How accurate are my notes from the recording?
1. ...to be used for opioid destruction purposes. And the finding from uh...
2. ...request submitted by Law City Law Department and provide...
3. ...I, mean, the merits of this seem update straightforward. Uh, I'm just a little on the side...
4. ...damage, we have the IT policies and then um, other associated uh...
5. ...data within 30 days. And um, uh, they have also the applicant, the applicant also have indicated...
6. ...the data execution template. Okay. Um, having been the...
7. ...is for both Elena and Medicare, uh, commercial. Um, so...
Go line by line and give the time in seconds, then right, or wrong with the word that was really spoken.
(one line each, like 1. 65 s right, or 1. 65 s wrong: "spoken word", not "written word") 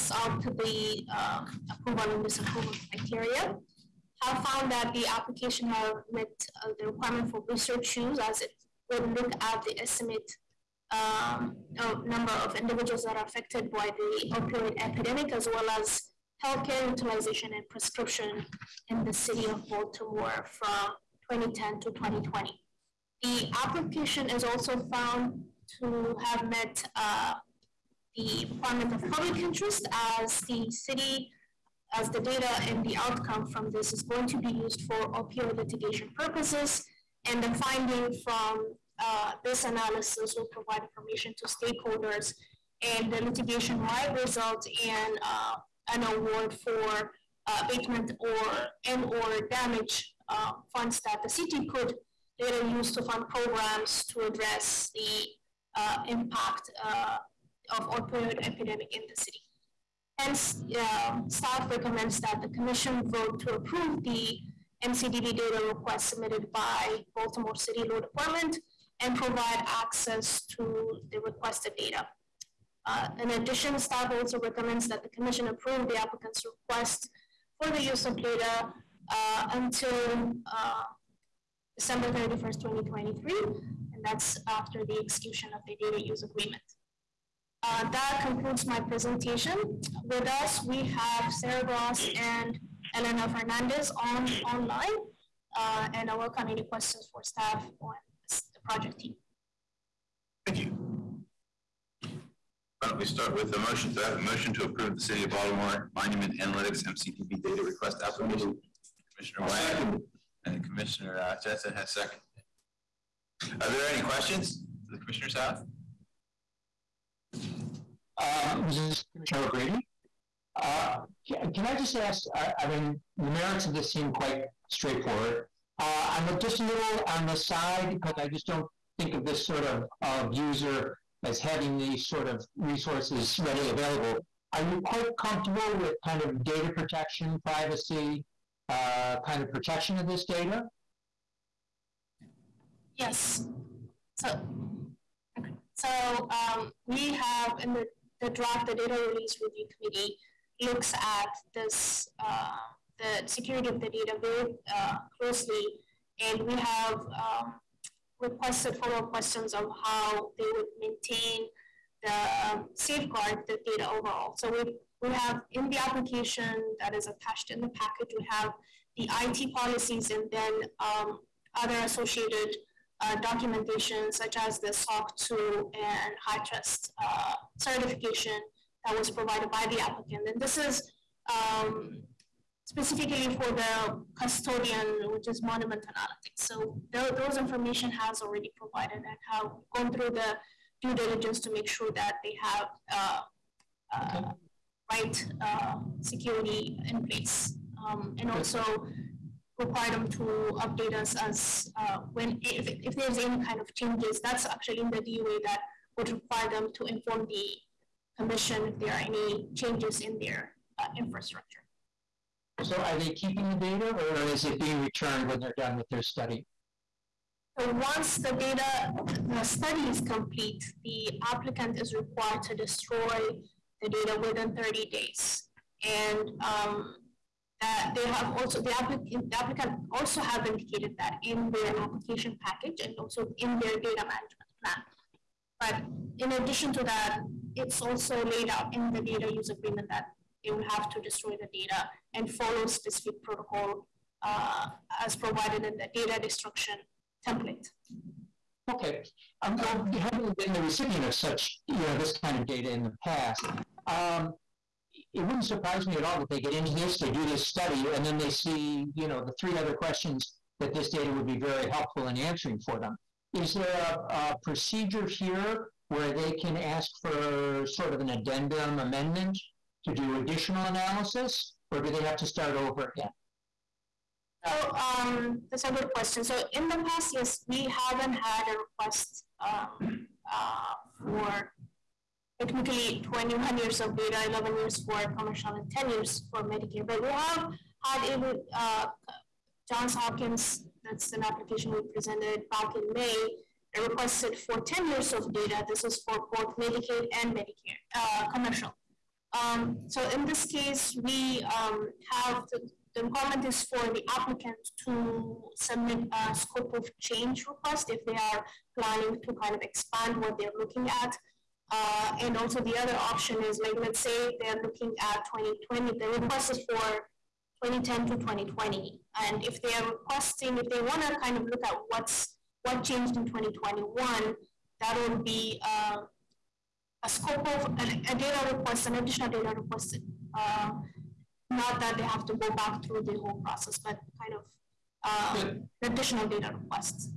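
1. 34 s wrong: "litigation", not "destruction"
2. 65 s wrong: "Baltimore", not "Law"
3. 122 s wrong: "quite", not "update"
4. 167 s wrong: "package", not "damage"
5. 223 s right
6. 245 s wrong: "destruction", not "execution"
7. 295 s wrong: "Medicaid", not "Elena".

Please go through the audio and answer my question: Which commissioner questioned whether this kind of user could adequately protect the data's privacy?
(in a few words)
O'Grady.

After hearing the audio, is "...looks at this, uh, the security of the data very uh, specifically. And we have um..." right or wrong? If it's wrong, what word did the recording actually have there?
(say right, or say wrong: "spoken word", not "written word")
wrong: "closely", not "specifically".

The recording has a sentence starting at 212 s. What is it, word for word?
So are they keeping the data or is it being returned when they're done with their study?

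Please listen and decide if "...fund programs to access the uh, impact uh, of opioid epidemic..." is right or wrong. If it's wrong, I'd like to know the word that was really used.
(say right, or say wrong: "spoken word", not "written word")
wrong: "address", not "access".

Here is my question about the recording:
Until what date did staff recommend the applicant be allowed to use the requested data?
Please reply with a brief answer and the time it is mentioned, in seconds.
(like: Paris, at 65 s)
December 31, 2023, at 81 s.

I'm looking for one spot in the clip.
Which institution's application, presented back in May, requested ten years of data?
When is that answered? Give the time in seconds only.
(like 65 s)
289 s.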